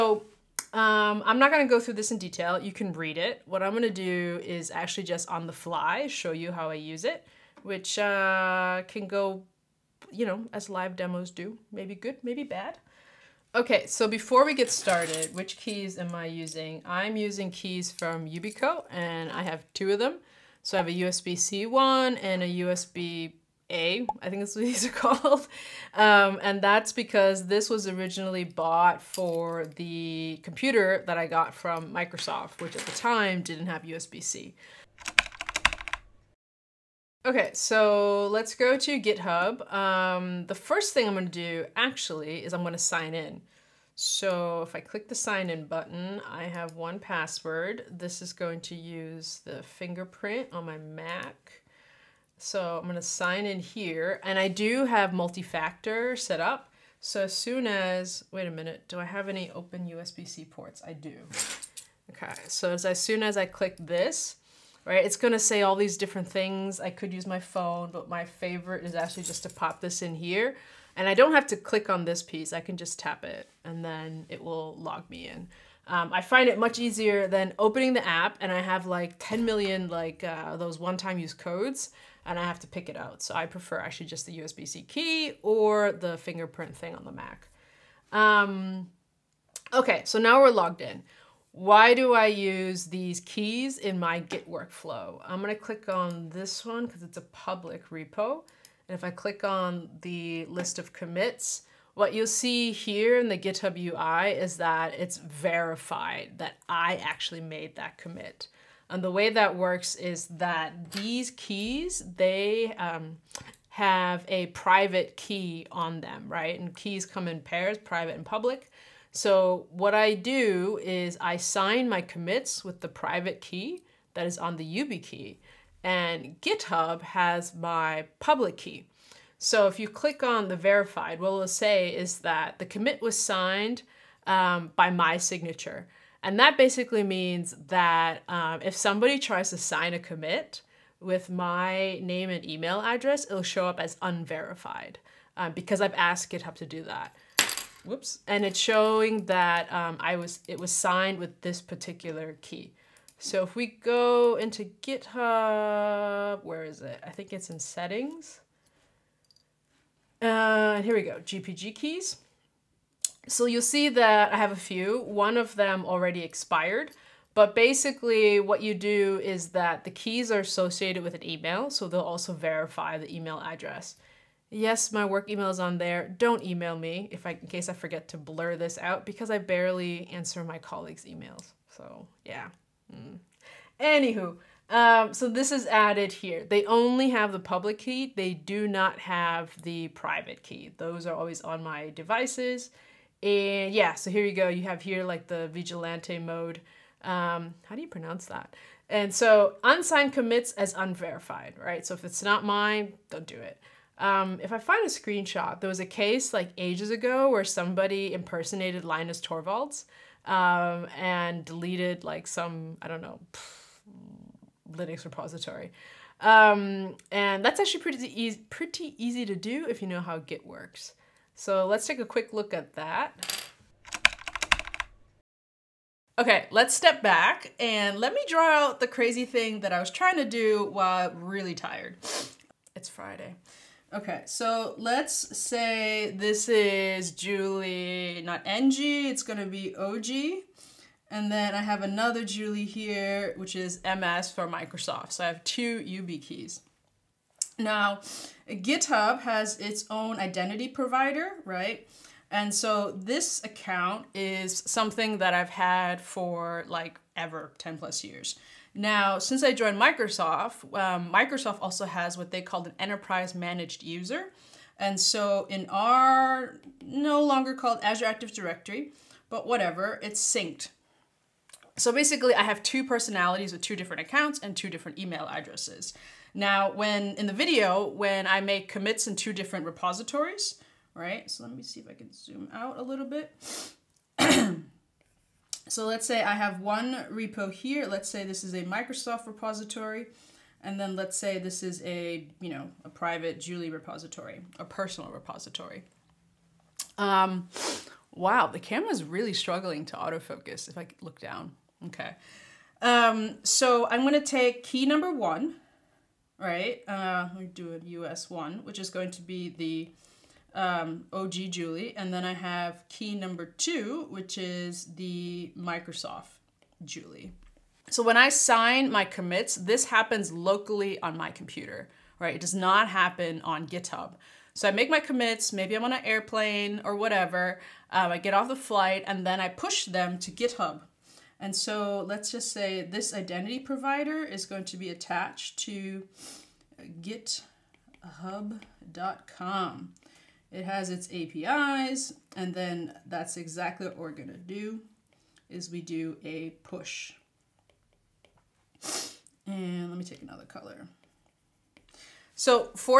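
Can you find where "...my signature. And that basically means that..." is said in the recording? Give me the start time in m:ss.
2:14.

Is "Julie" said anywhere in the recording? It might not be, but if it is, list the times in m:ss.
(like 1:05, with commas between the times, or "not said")
3:57, 4:02, 4:53, 5:11, 5:16.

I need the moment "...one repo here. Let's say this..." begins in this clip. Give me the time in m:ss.
4:46.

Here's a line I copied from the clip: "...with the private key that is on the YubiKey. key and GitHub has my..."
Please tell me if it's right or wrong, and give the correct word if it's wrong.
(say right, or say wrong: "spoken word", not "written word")
right.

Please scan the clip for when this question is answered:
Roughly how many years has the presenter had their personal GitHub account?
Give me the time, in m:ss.
4:17.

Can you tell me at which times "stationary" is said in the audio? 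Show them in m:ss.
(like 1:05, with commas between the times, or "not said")
not said.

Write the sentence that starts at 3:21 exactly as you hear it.
So if it's not mine, don't do it.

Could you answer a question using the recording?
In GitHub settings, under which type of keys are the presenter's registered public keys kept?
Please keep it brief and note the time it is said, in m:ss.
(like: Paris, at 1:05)
GPG keys, at 2:41.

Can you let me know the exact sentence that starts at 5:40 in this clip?
It has its APIs, and then that's exactly what we're gonna do is we do a push.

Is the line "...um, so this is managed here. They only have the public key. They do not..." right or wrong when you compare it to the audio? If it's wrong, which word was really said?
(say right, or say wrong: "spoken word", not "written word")
wrong: "added", not "managed".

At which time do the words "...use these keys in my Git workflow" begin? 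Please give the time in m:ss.
1:32.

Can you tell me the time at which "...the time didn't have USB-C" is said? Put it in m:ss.
0:32.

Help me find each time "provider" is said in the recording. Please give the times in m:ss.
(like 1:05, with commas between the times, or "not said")
4:10, 5:33.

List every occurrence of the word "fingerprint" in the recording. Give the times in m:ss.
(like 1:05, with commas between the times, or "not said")
0:49, 1:26.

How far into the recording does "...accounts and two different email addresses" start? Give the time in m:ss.
4:34.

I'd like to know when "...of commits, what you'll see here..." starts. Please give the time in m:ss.
1:40.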